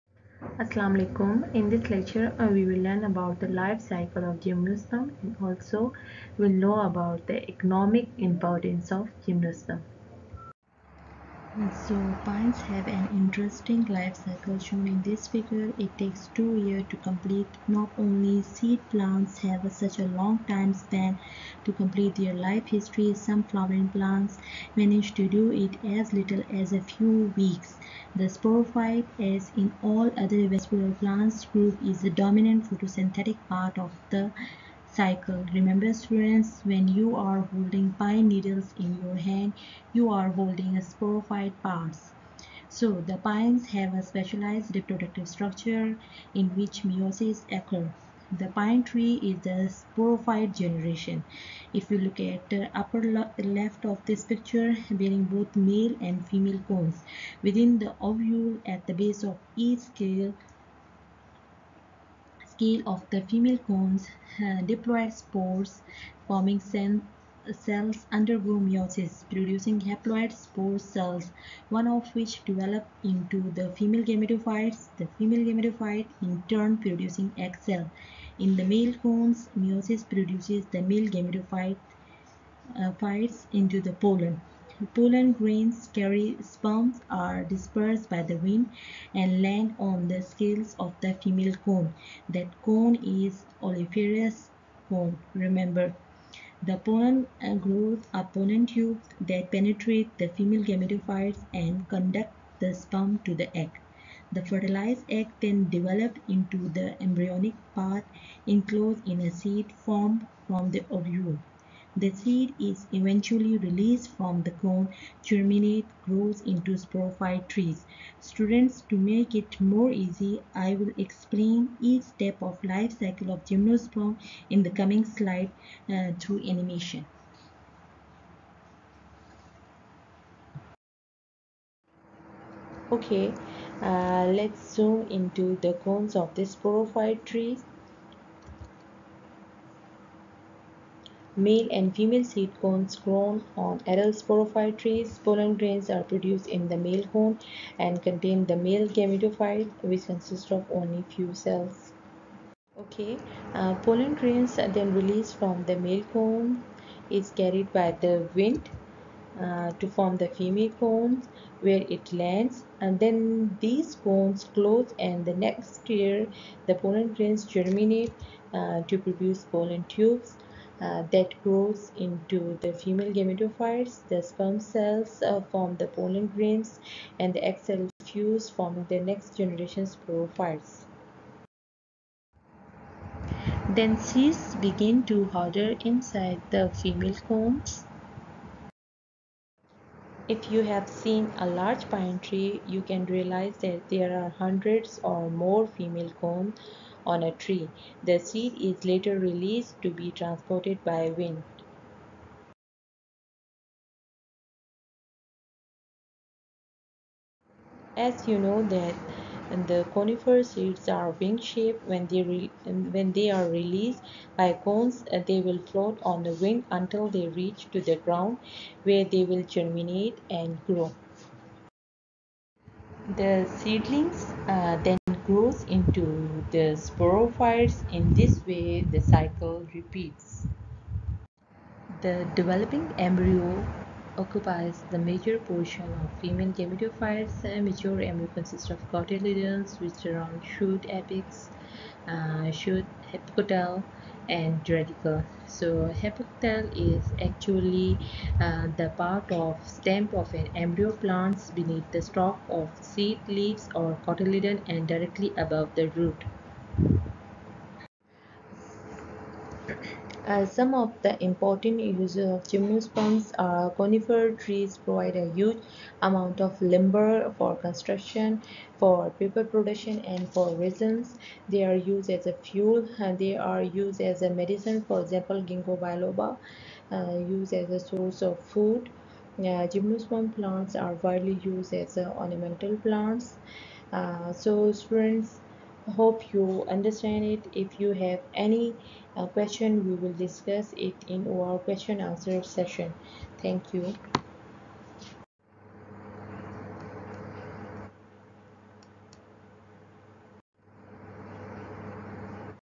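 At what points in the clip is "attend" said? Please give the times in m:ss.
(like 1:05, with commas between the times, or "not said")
not said.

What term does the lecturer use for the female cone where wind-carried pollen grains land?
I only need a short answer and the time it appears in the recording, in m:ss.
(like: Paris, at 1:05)
ovuliferous cone, at 1:33.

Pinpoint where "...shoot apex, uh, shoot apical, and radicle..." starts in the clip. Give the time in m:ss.
4:00.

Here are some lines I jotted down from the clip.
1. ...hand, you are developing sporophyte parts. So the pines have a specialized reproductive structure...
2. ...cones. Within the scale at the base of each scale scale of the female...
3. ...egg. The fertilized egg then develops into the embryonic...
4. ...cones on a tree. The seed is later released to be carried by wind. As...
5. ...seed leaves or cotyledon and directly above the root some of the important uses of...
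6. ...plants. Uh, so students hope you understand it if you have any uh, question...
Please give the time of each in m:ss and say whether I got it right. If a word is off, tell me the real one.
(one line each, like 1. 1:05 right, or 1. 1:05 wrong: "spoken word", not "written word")
1. 0:39 wrong: "holding", not "developing"
2. 0:56 wrong: "ovule", not "scale"
3. 1:43 right
4. 3:16 wrong: "transported", not "carried"
5. 4:12 right
6. 4:42 right.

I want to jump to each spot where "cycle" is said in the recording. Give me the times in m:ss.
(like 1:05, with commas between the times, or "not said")
0:03, 0:14, 0:34, 2:02, 3:49.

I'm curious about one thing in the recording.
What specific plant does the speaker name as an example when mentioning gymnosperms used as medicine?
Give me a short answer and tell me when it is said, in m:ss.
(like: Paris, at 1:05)
Ginkgo biloba, at 4:35.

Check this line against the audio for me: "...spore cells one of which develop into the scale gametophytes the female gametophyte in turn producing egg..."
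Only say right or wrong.
wrong.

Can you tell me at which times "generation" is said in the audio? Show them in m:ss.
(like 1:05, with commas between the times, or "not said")
0:50, 2:59.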